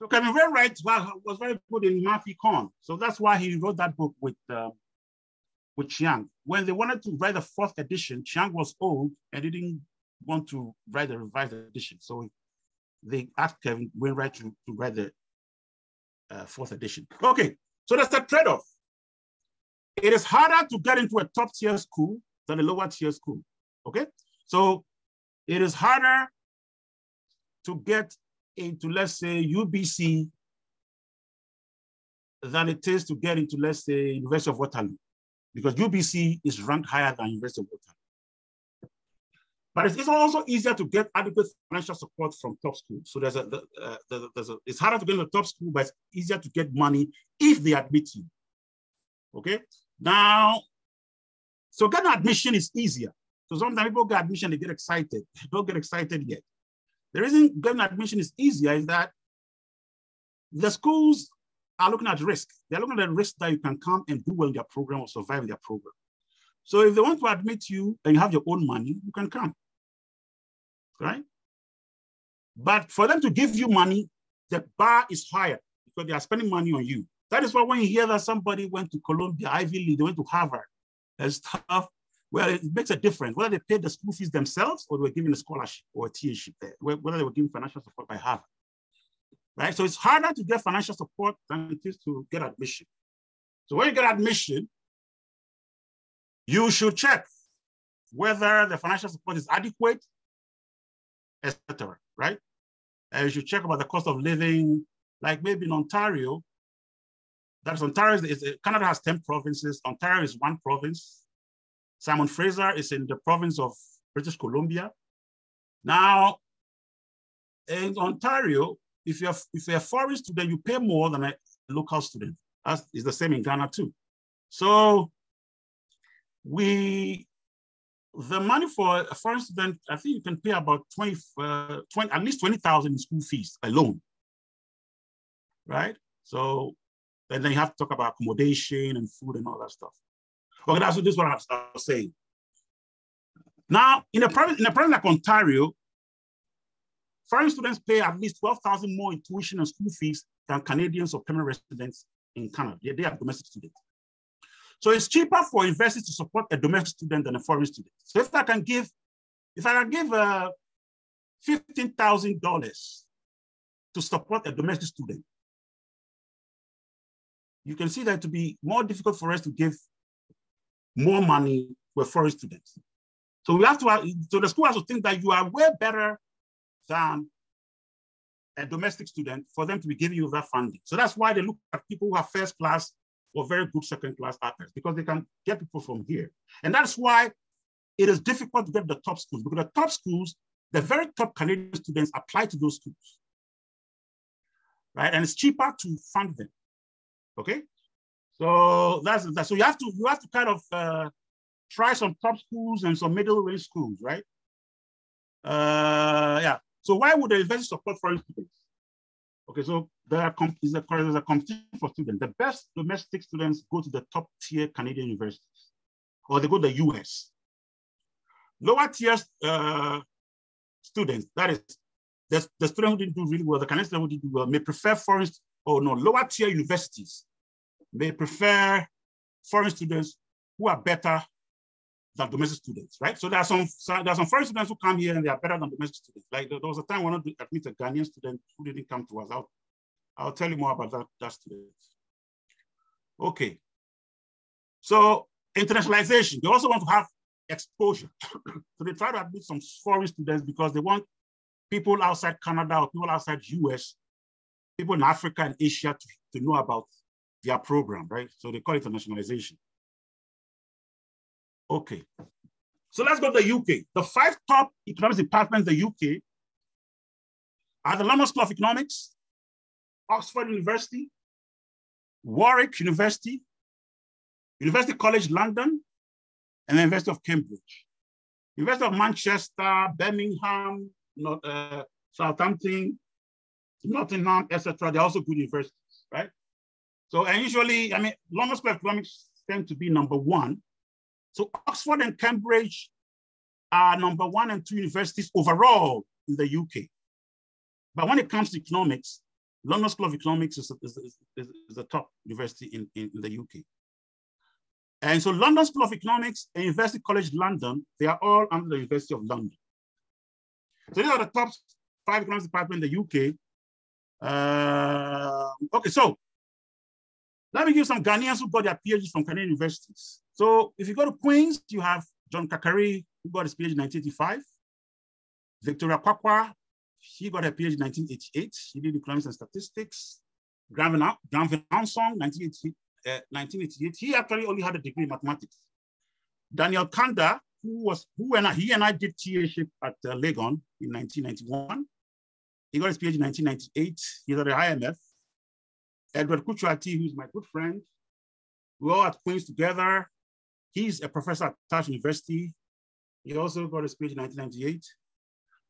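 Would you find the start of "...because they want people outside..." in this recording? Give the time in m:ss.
4:10.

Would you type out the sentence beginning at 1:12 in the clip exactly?
But for them to give you money, the bar is higher because they are spending money on you.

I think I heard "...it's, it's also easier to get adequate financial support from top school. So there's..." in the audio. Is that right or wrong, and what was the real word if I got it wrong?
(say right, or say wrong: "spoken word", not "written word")
right.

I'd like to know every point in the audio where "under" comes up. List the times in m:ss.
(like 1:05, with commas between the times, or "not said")
5:08.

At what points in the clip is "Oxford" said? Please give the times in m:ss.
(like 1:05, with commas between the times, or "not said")
4:30, 4:51.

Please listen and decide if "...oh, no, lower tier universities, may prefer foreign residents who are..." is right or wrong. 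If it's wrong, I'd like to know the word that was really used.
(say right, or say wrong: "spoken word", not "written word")
wrong: "students", not "residents".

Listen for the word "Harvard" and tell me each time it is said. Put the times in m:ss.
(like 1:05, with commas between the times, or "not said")
1:20, 1:28.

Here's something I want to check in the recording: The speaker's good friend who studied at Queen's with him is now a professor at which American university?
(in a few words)
Tufts University.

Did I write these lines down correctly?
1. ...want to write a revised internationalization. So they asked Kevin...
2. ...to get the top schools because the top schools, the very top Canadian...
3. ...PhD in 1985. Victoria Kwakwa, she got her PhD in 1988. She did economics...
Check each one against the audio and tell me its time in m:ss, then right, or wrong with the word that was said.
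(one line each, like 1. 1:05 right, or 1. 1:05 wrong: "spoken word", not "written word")
1. 0:10 wrong: "edition", not "internationalization"
2. 3:08 right
3. 5:23 right.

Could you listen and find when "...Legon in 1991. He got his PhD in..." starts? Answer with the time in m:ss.
5:40.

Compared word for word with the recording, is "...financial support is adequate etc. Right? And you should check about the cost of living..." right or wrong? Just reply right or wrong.
right.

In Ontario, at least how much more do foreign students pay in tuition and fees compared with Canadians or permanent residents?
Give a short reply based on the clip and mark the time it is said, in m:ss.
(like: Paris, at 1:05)
12,000, at 2:28.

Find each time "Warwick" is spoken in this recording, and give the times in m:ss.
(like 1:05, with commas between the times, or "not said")
4:32.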